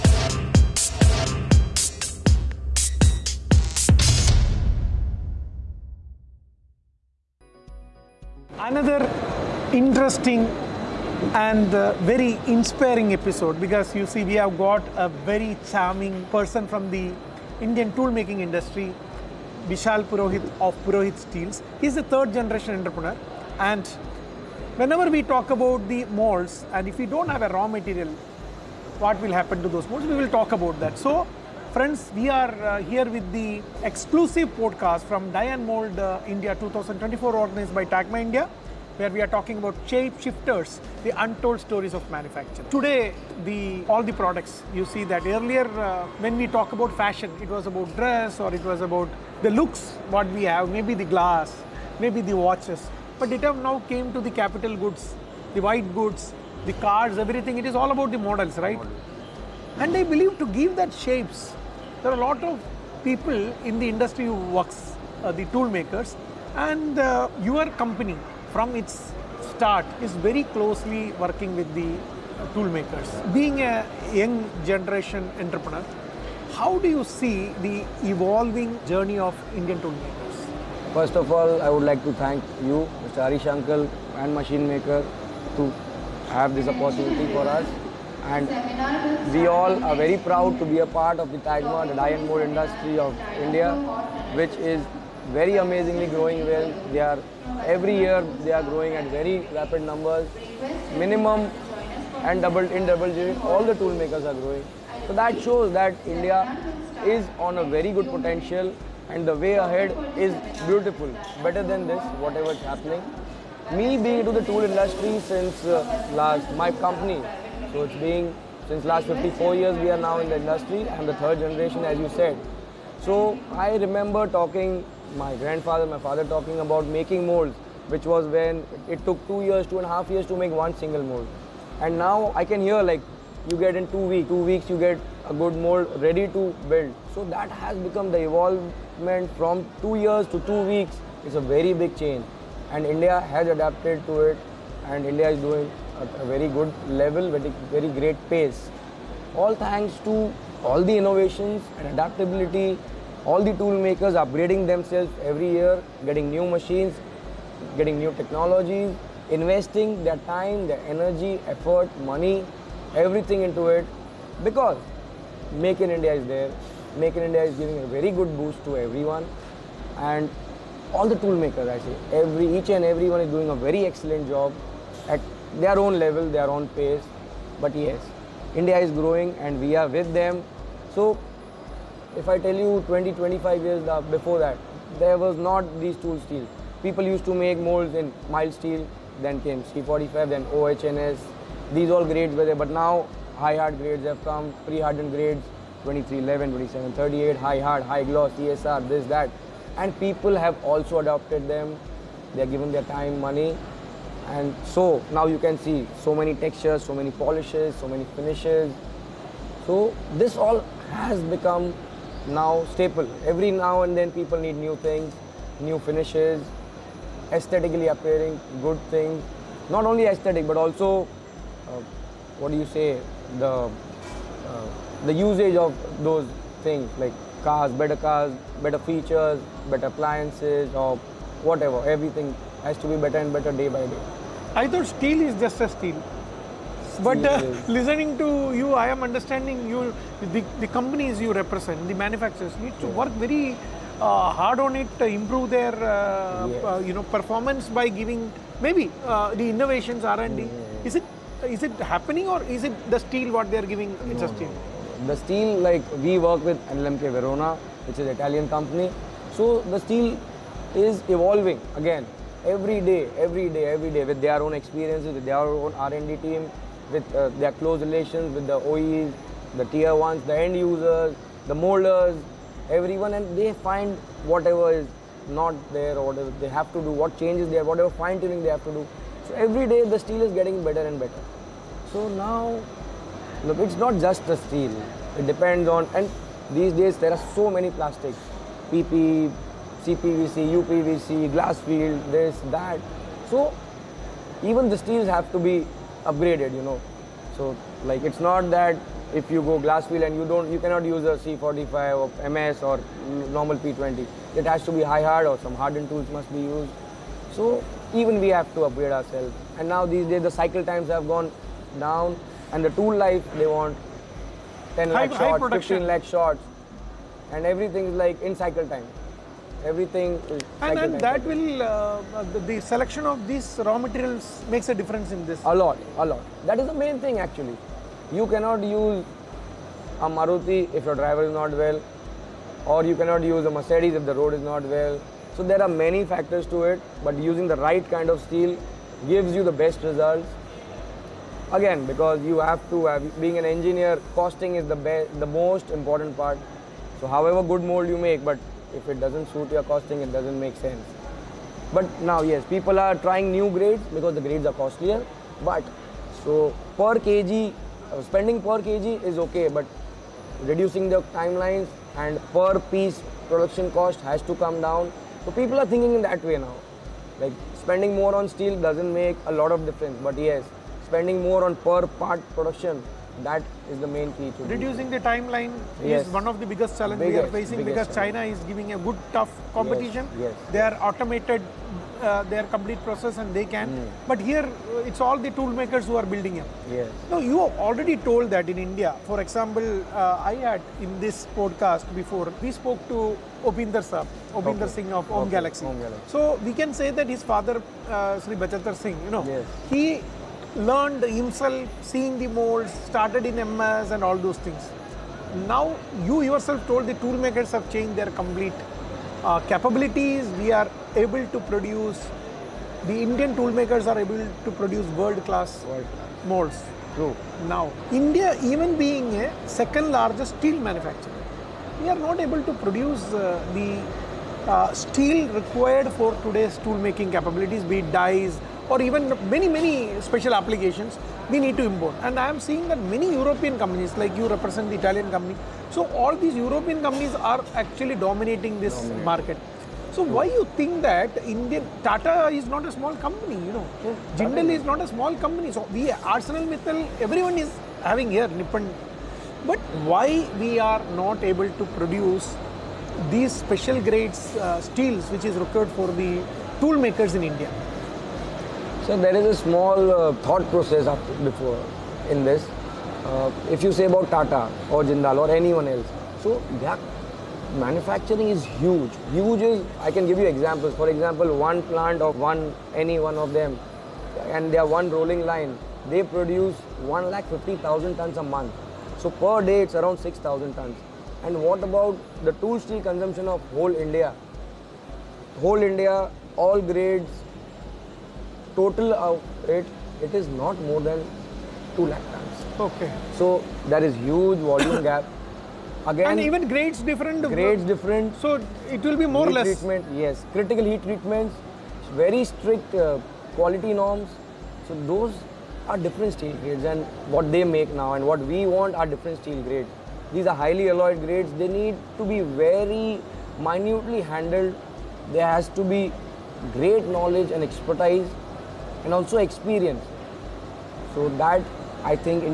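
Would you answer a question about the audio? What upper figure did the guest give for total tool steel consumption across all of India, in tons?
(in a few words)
2 lakh tons.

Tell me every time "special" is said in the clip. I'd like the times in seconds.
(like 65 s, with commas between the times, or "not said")
429 s, 453 s.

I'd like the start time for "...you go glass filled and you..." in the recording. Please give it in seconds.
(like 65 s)
299 s.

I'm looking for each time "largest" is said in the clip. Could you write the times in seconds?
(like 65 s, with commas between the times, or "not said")
419 s.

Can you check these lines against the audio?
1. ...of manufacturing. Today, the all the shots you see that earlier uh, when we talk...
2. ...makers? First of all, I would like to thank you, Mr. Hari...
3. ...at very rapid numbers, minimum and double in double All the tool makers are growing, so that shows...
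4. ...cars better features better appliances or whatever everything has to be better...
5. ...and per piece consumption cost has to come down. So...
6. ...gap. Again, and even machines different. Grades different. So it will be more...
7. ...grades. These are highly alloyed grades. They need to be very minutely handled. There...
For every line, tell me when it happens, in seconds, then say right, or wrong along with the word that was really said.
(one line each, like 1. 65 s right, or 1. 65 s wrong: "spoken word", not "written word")
1. 41 s wrong: "products", not "shots"
2. 79 s right
3. 98 s right
4. 227 s right
5. 361 s wrong: "production", not "consumption"
6. 494 s wrong: "grades", not "machines"
7. 509 s right.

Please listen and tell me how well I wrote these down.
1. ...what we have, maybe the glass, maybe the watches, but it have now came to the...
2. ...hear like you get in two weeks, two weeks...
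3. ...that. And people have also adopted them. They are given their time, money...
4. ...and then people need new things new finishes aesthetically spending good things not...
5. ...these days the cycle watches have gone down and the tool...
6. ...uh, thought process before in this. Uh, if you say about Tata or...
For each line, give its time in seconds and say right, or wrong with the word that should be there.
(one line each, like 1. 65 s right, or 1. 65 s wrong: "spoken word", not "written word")
1. 50 s right
2. 132 s right
3. 199 s right
4. 213 s wrong: "appearing", not "spending"
5. 309 s wrong: "times", not "watches"
6. 459 s right.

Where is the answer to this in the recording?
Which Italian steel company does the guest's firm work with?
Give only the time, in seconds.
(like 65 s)
256 s.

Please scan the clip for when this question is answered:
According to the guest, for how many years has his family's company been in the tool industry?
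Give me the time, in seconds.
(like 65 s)
119 s.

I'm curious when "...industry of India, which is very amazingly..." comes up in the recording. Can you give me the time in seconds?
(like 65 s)
92 s.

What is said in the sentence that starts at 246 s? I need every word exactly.
Uh, you know performance by giving maybe uh, the innovations R and D.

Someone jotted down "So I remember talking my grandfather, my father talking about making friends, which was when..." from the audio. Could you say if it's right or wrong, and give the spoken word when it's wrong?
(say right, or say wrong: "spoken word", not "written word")
wrong: "molds", not "friends".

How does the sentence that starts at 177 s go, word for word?
But yes, India is growing and we are with them.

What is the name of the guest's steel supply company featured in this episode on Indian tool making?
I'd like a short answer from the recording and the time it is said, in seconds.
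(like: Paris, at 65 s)
Purohit Steels, at 20 s.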